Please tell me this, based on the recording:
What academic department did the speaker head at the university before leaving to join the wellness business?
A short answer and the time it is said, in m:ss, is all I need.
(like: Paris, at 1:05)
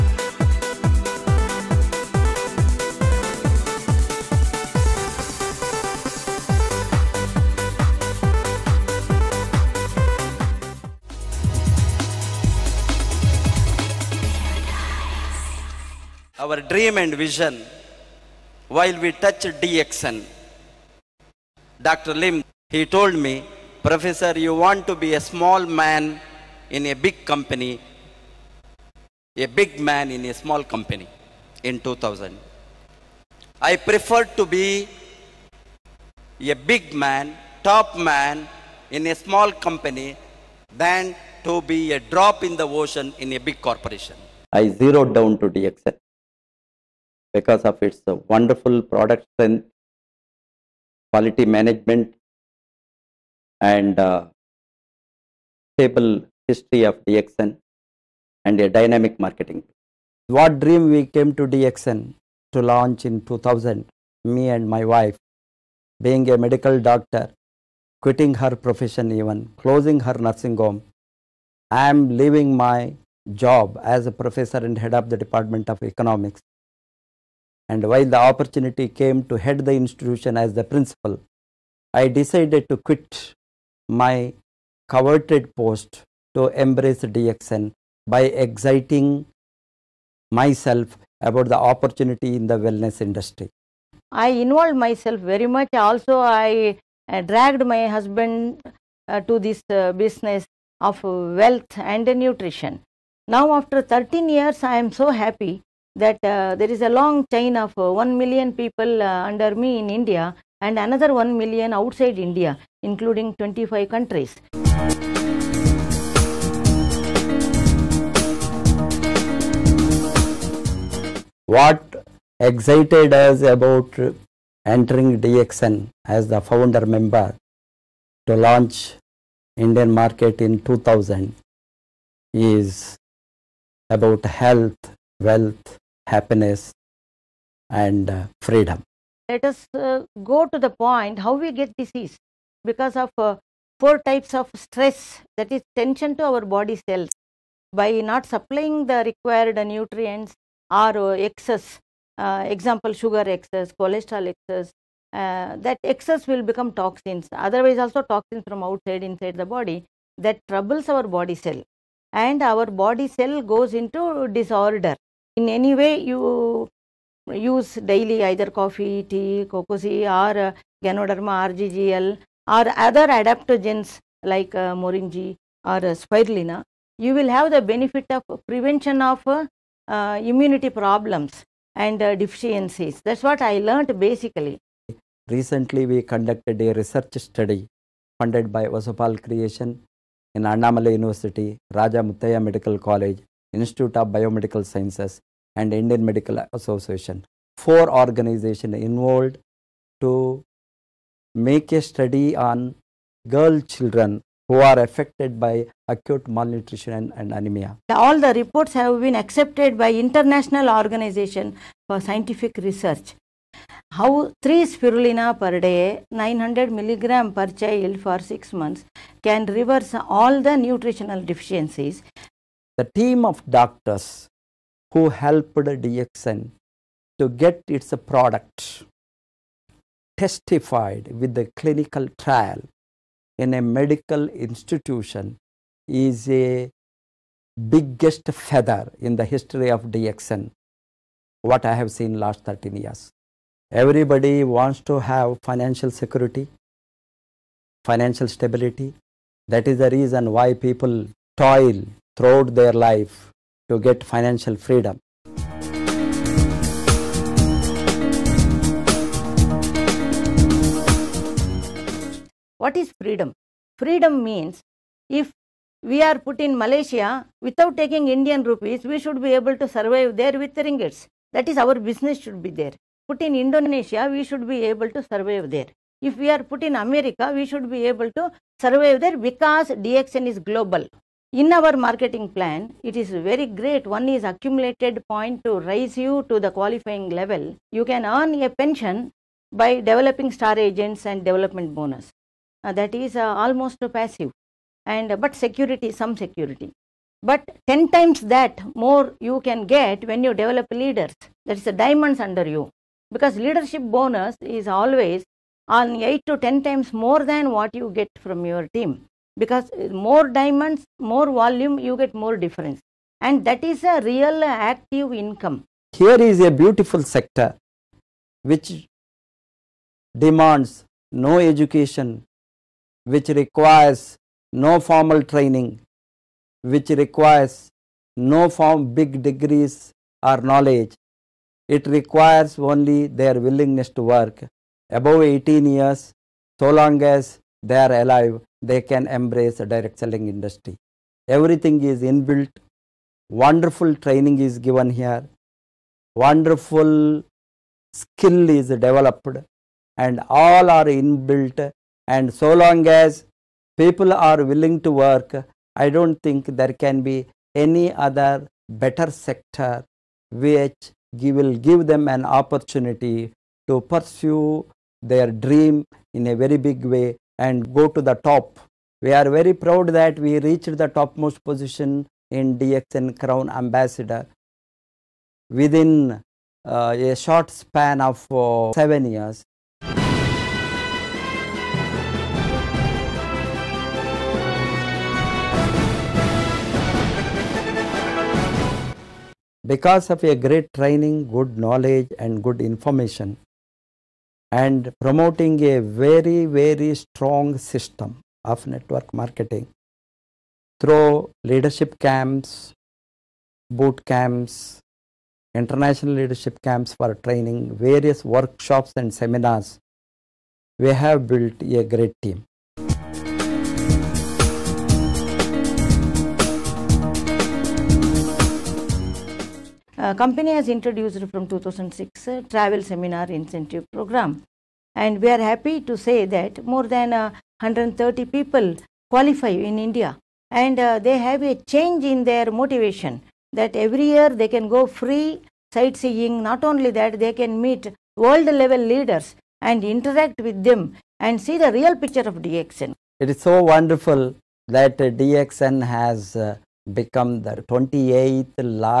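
Economics, at 1:15.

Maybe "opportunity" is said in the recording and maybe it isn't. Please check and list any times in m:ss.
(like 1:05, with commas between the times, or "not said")
1:18, 1:31, 6:02.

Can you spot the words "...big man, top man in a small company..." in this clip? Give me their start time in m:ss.
0:36.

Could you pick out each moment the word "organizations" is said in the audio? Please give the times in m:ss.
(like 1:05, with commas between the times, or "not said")
3:17, 3:30.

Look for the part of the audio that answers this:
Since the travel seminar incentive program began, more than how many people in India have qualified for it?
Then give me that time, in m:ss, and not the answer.
7:07.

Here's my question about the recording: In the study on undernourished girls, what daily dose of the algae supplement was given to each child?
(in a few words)
900 milligrams.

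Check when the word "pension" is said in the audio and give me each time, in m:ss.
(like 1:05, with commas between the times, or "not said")
4:48.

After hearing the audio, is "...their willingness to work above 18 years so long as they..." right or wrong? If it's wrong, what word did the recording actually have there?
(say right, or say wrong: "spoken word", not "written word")
right.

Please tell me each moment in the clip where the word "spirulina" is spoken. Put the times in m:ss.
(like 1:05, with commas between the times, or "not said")
2:56, 3:34.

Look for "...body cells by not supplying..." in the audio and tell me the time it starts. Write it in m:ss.
2:26.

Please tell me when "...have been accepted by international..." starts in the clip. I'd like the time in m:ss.
3:28.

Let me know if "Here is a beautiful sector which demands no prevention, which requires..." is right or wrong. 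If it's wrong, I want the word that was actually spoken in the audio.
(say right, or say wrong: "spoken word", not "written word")
wrong: "education", not "prevention".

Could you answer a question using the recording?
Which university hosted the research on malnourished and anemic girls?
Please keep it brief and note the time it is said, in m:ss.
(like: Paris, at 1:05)
Annamalai University, at 3:10.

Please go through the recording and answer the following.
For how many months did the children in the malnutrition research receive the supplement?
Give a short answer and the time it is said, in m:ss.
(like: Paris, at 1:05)
6, at 3:38.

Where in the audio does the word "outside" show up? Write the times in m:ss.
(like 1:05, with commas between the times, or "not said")
1:51, 2:38.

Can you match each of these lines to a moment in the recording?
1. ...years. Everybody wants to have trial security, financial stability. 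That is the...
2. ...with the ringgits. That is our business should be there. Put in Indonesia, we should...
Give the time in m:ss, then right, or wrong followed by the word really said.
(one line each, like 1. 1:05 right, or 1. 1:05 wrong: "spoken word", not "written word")
1. 4:02 wrong: "financial", not "trial"
2. 4:30 right.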